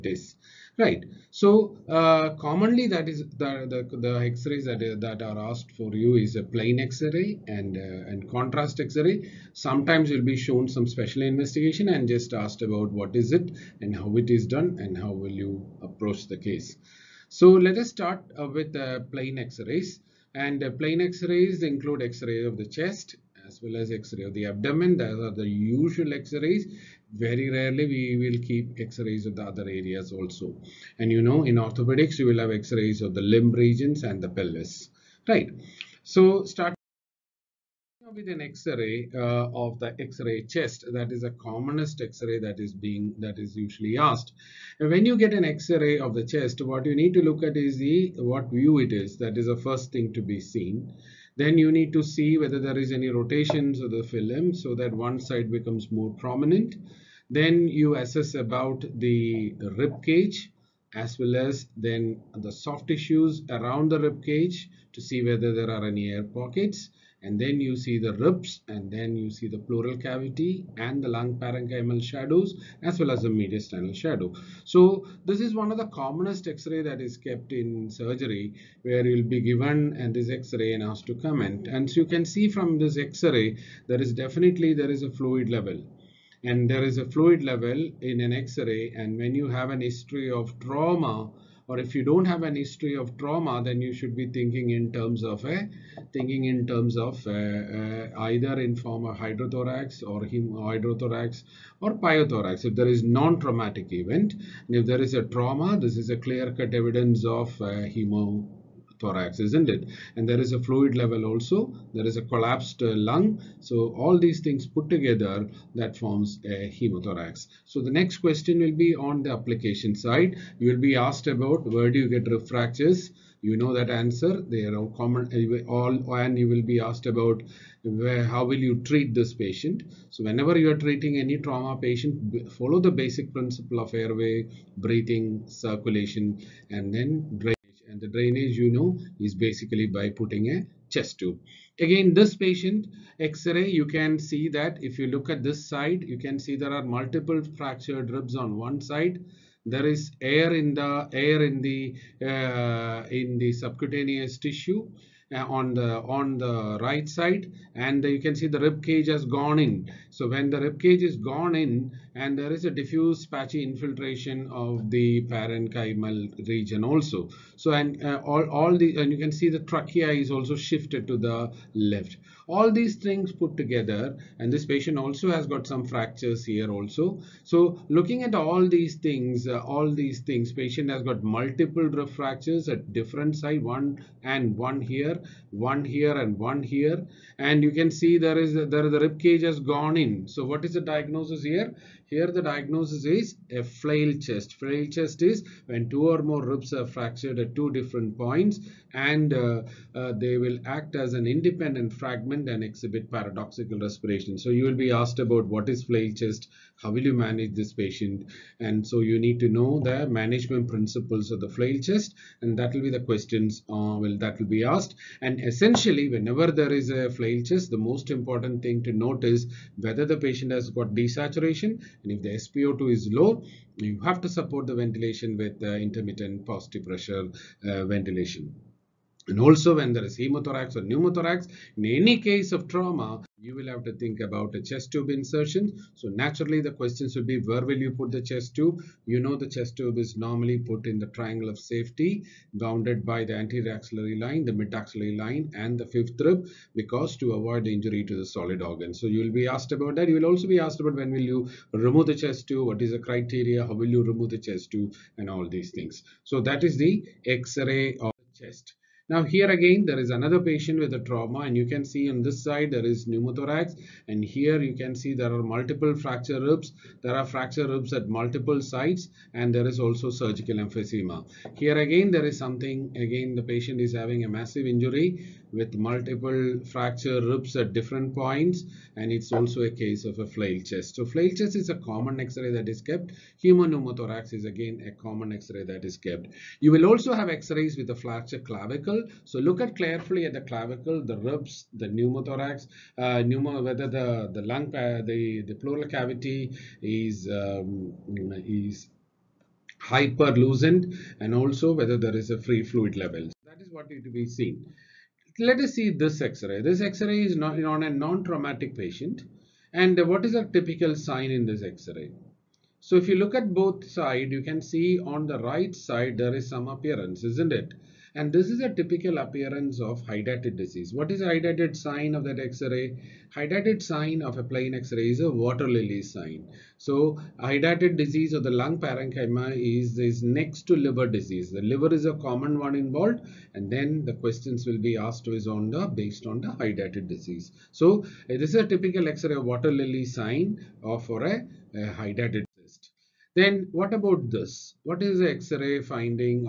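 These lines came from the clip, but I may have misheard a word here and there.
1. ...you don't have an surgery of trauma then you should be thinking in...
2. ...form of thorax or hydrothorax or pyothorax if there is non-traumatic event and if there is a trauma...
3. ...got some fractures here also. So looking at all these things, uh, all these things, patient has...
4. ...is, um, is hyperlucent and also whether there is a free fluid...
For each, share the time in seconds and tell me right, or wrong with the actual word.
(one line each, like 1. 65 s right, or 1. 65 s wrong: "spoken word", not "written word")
1. 91 s wrong: "history", not "surgery"
2. 98 s wrong: "hydrothorax", not "thorax"
3. 175 s right
4. 296 s right.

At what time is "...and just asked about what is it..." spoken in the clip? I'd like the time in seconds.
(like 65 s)
11 s.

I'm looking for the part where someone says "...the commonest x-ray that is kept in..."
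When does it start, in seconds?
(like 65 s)
75 s.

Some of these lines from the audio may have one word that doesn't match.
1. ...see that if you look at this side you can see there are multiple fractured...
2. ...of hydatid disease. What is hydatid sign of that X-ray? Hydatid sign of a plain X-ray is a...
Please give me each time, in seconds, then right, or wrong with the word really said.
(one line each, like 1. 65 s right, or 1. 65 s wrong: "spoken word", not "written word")
1. 144 s right
2. 319 s right.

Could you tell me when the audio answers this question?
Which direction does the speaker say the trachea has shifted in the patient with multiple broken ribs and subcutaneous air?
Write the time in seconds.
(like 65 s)
170 s.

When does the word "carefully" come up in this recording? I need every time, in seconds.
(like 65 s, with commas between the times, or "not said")
289 s.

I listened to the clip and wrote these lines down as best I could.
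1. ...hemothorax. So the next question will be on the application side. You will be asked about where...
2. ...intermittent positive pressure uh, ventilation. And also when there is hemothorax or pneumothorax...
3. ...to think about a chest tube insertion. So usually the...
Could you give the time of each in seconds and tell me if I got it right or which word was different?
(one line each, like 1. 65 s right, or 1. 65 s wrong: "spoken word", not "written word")
1. 116 s right
2. 225 s right
3. 233 s wrong: "naturally", not "usually".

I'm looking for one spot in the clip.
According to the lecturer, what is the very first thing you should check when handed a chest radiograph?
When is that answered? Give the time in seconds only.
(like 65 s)
48 s.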